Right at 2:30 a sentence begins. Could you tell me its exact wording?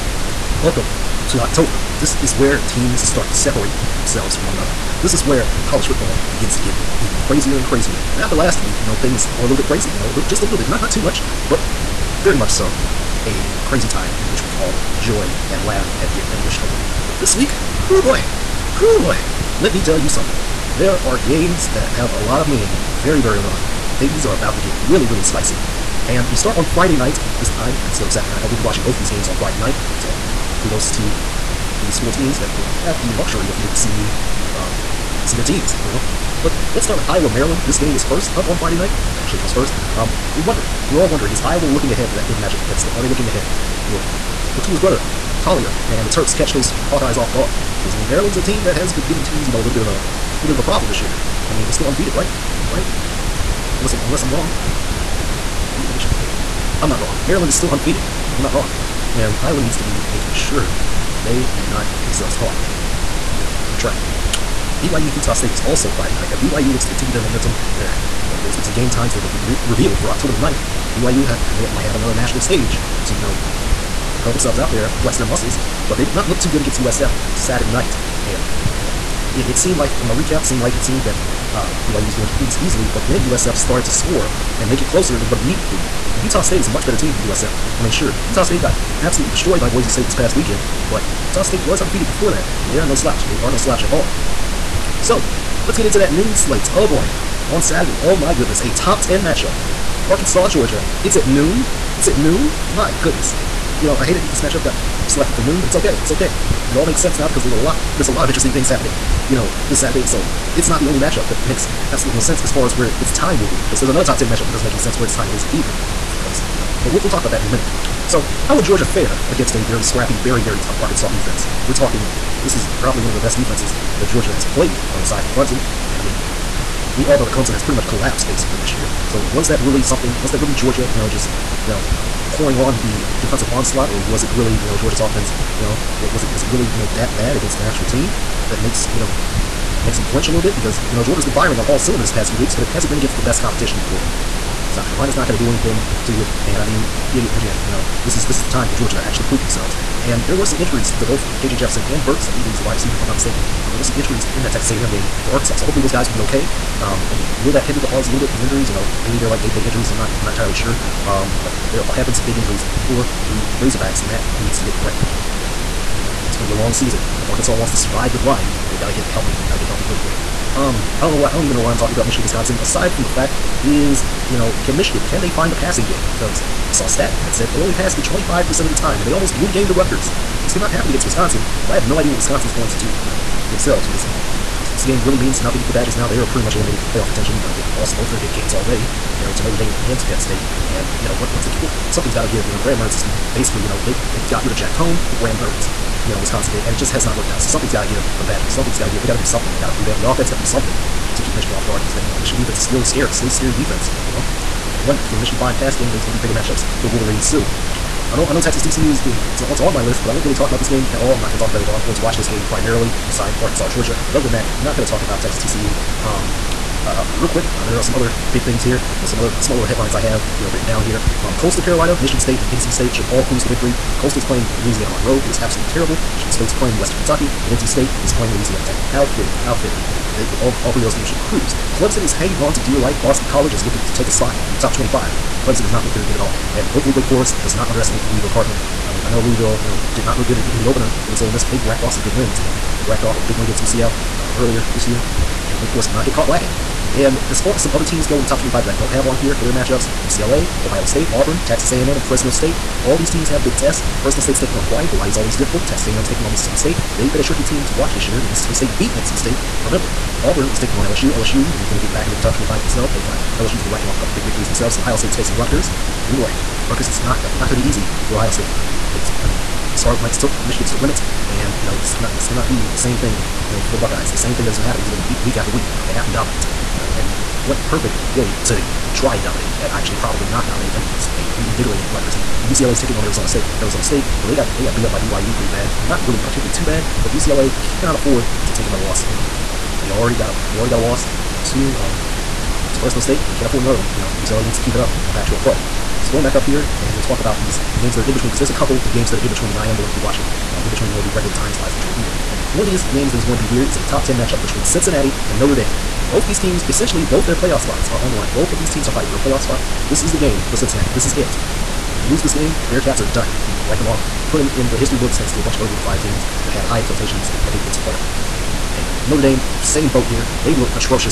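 And there were some injuries to both KJ Jefferson and Burks.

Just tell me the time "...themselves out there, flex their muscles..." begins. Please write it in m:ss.
1:14.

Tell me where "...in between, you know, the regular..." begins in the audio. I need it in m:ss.
5:00.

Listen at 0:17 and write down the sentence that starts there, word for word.
But this week, oh boy, oh boy, let me tell you something.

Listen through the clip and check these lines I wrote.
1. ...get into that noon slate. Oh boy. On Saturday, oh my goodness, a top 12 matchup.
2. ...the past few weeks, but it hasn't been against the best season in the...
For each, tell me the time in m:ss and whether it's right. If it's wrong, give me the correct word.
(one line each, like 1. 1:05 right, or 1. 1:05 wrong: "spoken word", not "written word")
1. 1:35 wrong: "10", not "12"
2. 2:22 wrong: "competition", not "season".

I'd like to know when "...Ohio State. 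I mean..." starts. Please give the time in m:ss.
4:28.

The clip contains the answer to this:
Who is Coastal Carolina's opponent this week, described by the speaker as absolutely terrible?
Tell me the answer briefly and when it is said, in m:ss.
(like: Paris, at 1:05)
Louisiana Monroe, at 3:44.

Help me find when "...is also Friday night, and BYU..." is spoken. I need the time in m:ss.
1:05.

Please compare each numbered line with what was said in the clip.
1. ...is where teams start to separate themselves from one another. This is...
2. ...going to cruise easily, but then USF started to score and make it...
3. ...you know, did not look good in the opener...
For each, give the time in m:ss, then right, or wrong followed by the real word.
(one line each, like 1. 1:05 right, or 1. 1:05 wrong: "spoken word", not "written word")
1. 0:02 right
2. 1:22 right
3. 3:59 right.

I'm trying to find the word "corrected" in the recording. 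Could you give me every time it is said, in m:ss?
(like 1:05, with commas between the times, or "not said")
2:44.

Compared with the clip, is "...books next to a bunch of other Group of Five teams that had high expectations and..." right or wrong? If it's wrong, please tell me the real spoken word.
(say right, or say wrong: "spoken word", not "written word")
right.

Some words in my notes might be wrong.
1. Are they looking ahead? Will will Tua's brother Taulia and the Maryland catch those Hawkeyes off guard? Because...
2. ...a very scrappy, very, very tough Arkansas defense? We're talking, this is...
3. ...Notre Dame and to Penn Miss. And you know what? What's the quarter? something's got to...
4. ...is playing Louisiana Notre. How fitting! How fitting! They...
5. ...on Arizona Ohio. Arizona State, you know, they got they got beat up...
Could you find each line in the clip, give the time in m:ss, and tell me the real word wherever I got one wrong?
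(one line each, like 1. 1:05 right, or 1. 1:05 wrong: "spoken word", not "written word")
1. 0:42 wrong: "Terps", not "Maryland"
2. 1:59 right
3. 3:09 wrong: "State", not "Miss"
4. 3:48 wrong: "Tech", not "Notre"
5. 4:42 wrong: "State", not "Ohio".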